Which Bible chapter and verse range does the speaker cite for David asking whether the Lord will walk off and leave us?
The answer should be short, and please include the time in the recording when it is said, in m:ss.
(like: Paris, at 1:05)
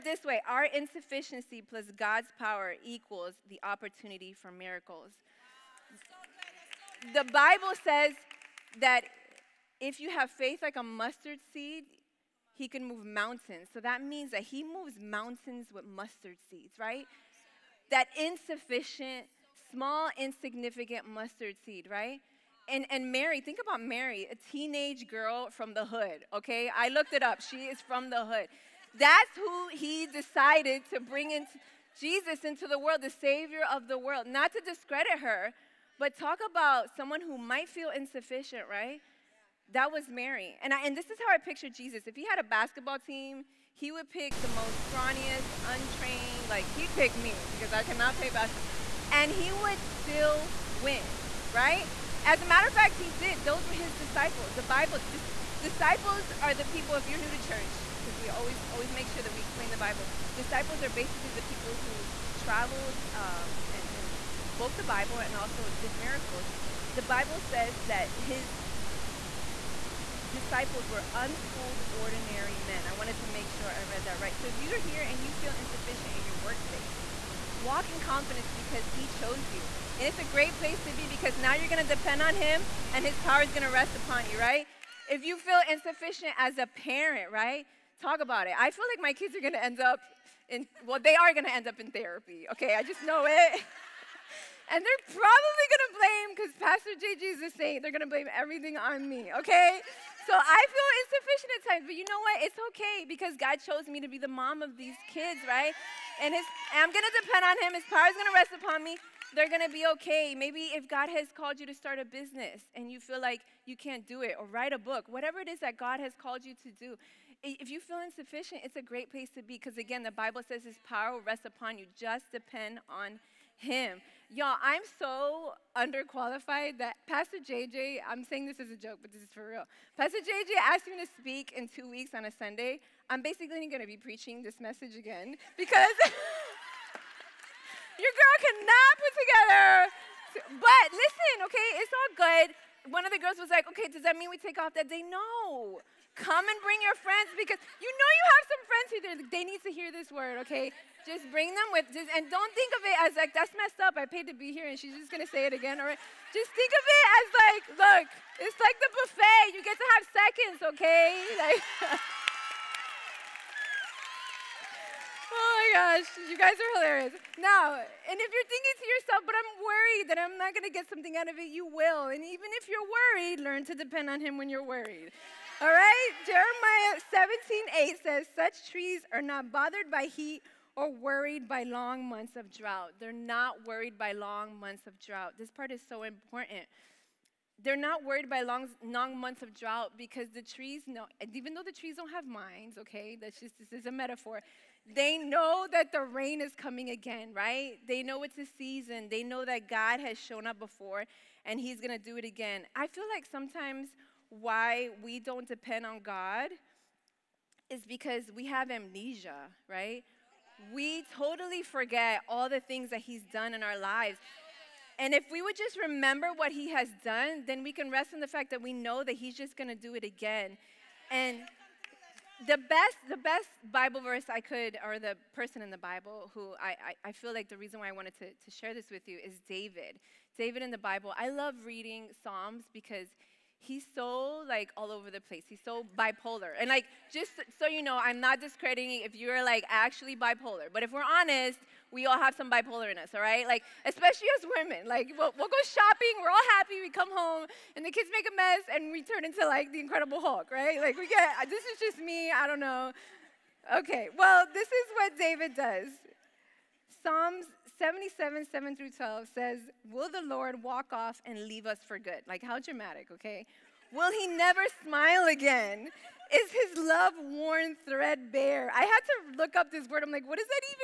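Psalms 77:7-12, at 4:17.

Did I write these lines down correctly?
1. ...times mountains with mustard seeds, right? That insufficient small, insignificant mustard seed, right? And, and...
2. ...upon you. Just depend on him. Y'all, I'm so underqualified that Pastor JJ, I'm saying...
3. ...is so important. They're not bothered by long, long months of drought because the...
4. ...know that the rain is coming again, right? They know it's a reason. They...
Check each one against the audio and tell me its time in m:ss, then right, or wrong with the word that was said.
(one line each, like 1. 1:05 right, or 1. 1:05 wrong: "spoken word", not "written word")
1. 0:14 wrong: "moves", not "times"
2. 2:01 right
3. 3:05 wrong: "worried", not "bothered"
4. 3:15 wrong: "season", not "reason".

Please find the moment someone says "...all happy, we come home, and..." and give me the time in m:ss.
4:06.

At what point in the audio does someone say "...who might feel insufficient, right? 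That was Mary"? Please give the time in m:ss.
0:37.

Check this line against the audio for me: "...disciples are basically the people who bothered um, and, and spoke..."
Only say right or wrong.
wrong.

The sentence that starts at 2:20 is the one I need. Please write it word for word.
But listen, okay, it's all good one of the girls was like, okay, does that mean we take off that day?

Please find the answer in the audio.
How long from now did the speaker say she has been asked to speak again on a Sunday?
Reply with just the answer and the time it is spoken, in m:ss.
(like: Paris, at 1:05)
2 weeks, at 2:11.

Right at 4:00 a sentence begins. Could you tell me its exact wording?
But if we're honest, we all have some bipolar in us, all right?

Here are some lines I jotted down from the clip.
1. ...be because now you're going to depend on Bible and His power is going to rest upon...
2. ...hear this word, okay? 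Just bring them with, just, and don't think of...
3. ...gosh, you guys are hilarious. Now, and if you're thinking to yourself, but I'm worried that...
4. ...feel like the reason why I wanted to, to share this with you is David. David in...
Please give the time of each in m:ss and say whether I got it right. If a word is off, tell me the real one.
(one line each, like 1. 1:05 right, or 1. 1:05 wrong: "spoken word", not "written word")
1. 1:20 wrong: "Him", not "Bible"
2. 2:29 right
3. 2:45 right
4. 3:47 right.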